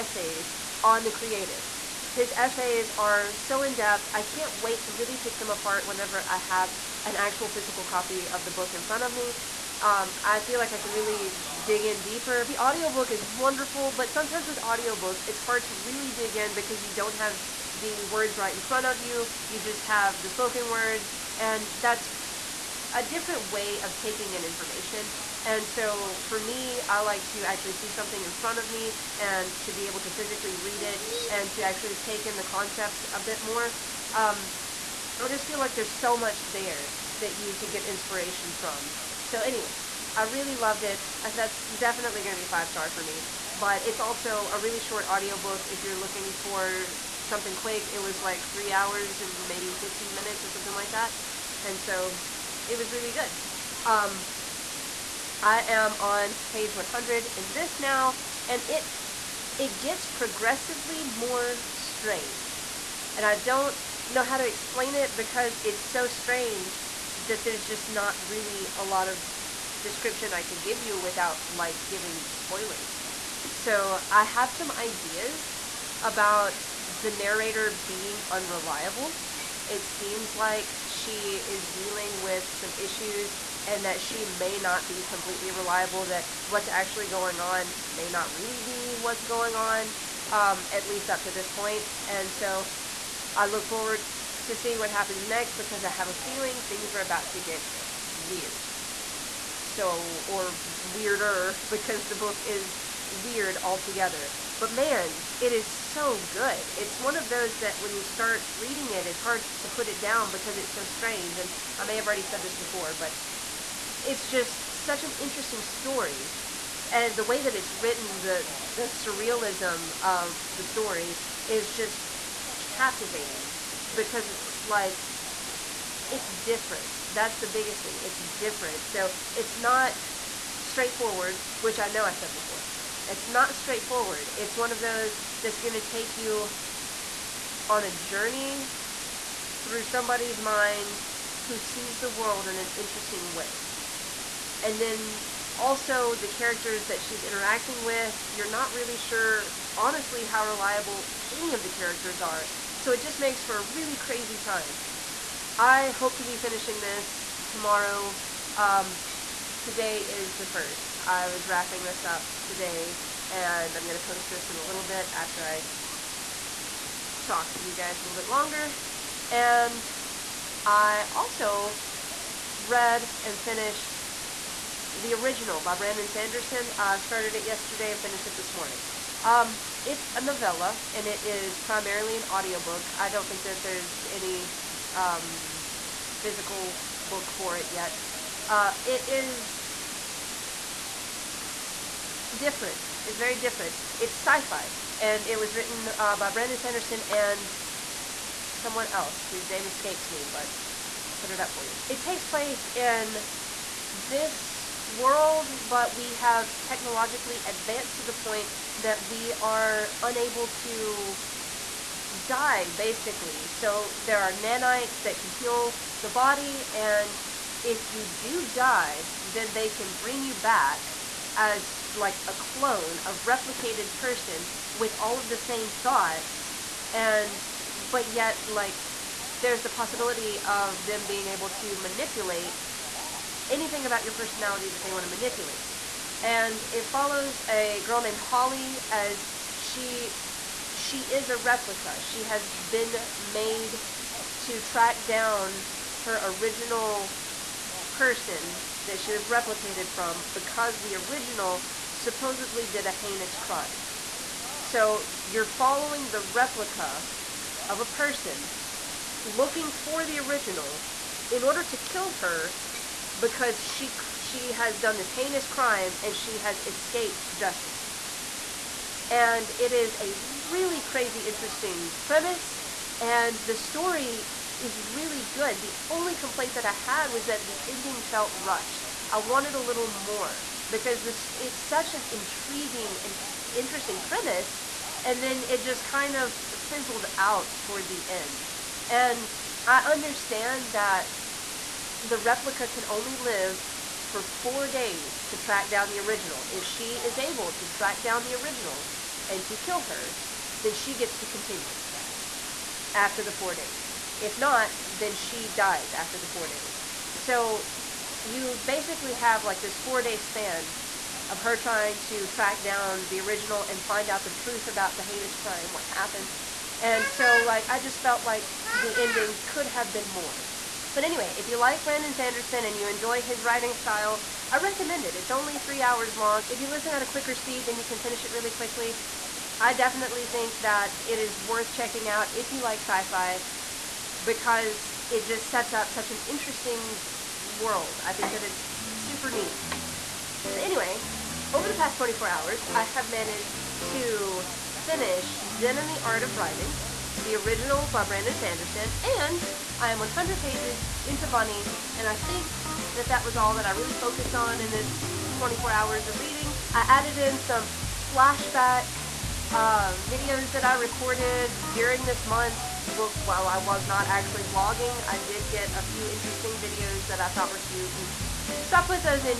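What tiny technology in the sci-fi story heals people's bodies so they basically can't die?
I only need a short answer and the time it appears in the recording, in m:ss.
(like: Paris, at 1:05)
nanites, at 3:34.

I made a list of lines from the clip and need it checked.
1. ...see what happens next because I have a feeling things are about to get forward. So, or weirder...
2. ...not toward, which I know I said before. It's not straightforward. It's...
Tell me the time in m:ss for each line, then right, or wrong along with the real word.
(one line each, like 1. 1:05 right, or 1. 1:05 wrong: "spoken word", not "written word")
1. 1:34 wrong: "weird", not "forward"
2. 2:09 wrong: "straightforward", not "toward".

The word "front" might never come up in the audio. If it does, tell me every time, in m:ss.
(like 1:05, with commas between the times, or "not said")
0:08, 0:18, 0:28.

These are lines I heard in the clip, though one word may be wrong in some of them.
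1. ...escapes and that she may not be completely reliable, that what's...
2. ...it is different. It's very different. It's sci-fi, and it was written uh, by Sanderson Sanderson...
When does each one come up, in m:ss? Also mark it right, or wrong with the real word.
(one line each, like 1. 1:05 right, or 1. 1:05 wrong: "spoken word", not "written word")
1. 1:22 wrong: "issues", not "escapes"
2. 3:08 wrong: "Brandon", not "Sanderson".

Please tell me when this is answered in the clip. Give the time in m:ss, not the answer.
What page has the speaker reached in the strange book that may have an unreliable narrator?
0:56.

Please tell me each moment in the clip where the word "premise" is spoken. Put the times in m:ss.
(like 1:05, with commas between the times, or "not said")
4:32, 4:43.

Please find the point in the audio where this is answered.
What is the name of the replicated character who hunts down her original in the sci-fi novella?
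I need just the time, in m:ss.
3:58.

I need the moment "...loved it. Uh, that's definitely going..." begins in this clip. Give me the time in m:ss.
0:40.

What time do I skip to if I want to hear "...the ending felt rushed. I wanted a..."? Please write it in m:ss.
4:37.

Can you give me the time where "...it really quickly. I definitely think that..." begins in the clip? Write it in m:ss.
5:28.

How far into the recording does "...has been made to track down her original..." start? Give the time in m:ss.
4:02.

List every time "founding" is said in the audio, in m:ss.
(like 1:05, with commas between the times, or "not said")
not said.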